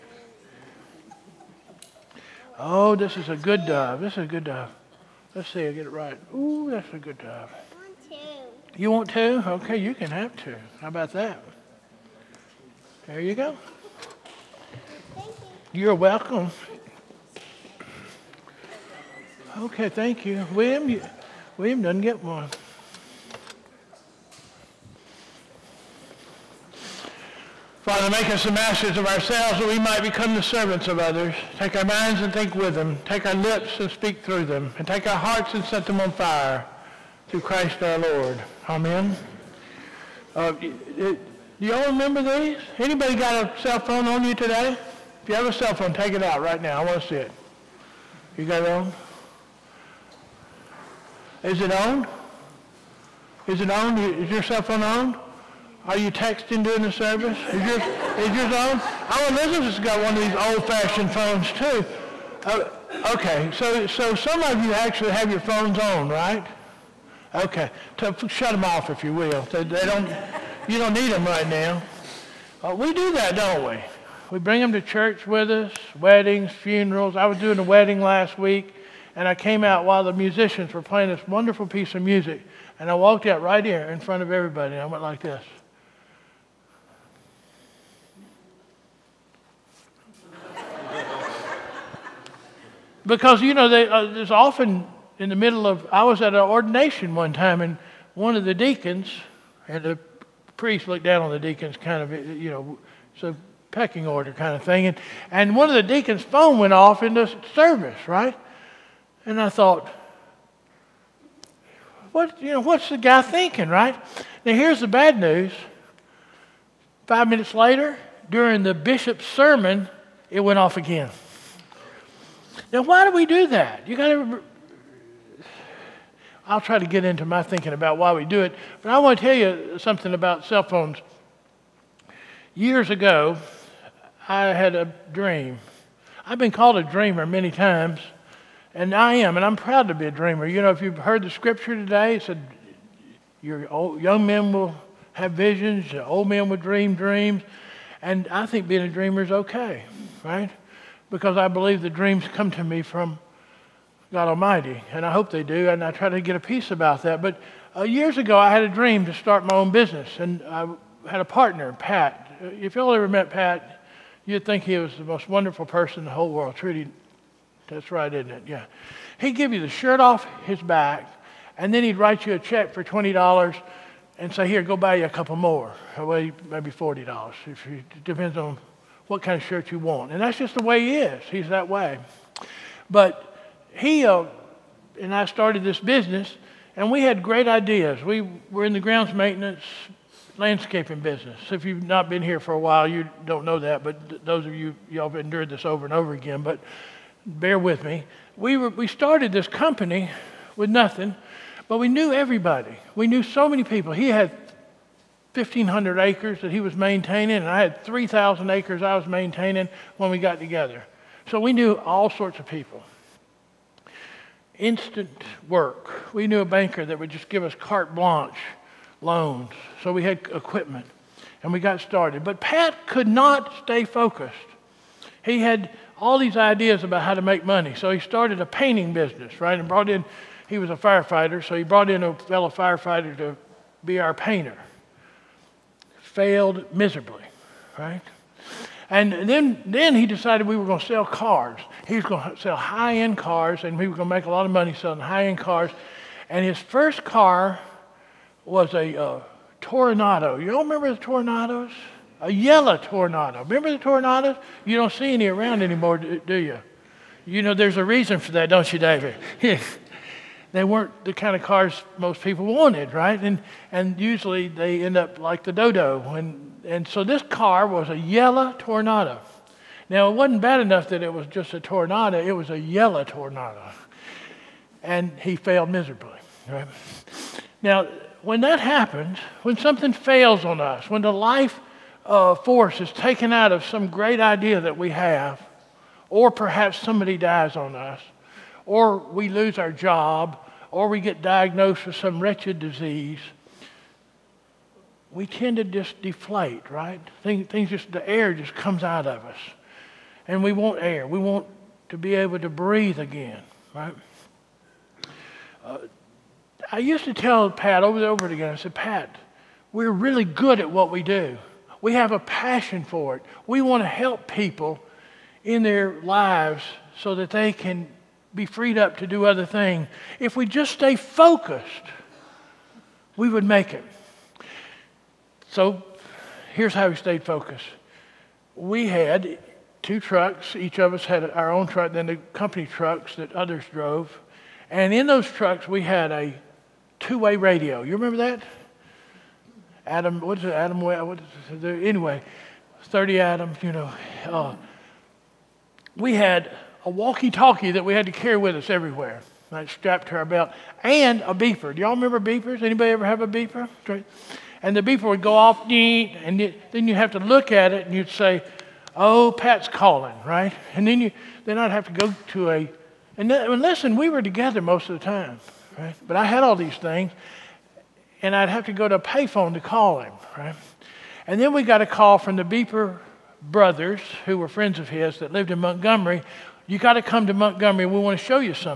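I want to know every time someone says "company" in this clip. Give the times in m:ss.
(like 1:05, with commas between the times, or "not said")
3:19, 5:32.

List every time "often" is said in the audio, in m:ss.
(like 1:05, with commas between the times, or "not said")
1:34.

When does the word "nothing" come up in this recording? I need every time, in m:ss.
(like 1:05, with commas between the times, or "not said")
3:20.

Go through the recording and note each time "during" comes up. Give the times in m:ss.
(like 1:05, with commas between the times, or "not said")
0:56, 1:58.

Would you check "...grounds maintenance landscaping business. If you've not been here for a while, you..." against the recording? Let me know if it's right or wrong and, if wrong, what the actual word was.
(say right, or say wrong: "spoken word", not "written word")
right.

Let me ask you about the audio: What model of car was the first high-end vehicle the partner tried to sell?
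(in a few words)
Toronado.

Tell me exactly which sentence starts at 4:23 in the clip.
And, and usually they end up like the Dodo.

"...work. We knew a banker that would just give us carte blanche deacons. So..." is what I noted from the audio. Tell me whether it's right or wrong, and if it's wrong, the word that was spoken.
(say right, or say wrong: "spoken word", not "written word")
wrong: "loans", not "deacons".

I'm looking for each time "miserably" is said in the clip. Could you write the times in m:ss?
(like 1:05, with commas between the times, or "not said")
3:56, 4:35.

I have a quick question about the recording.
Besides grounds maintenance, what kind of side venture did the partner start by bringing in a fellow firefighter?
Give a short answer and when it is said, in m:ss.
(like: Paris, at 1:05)
painting business, at 3:48.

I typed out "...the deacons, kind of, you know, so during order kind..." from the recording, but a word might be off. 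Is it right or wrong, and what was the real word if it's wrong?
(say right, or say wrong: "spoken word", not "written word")
wrong: "pecking", not "during".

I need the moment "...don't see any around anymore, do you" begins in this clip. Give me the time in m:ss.
4:14.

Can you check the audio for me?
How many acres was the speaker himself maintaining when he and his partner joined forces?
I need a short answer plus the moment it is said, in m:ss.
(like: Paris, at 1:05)
3,000, at 3:27.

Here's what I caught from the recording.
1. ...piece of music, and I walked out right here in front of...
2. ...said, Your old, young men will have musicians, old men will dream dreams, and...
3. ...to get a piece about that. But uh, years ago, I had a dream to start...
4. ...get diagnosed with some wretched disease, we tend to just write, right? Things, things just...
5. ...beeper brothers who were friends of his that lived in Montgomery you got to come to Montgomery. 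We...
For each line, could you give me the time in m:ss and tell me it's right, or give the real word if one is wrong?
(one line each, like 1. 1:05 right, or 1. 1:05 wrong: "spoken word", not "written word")
1. 1:21 right
2. 2:22 wrong: "visions", not "musicians"
3. 2:36 right
4. 4:50 wrong: "deflate", not "write"
5. 6:12 right.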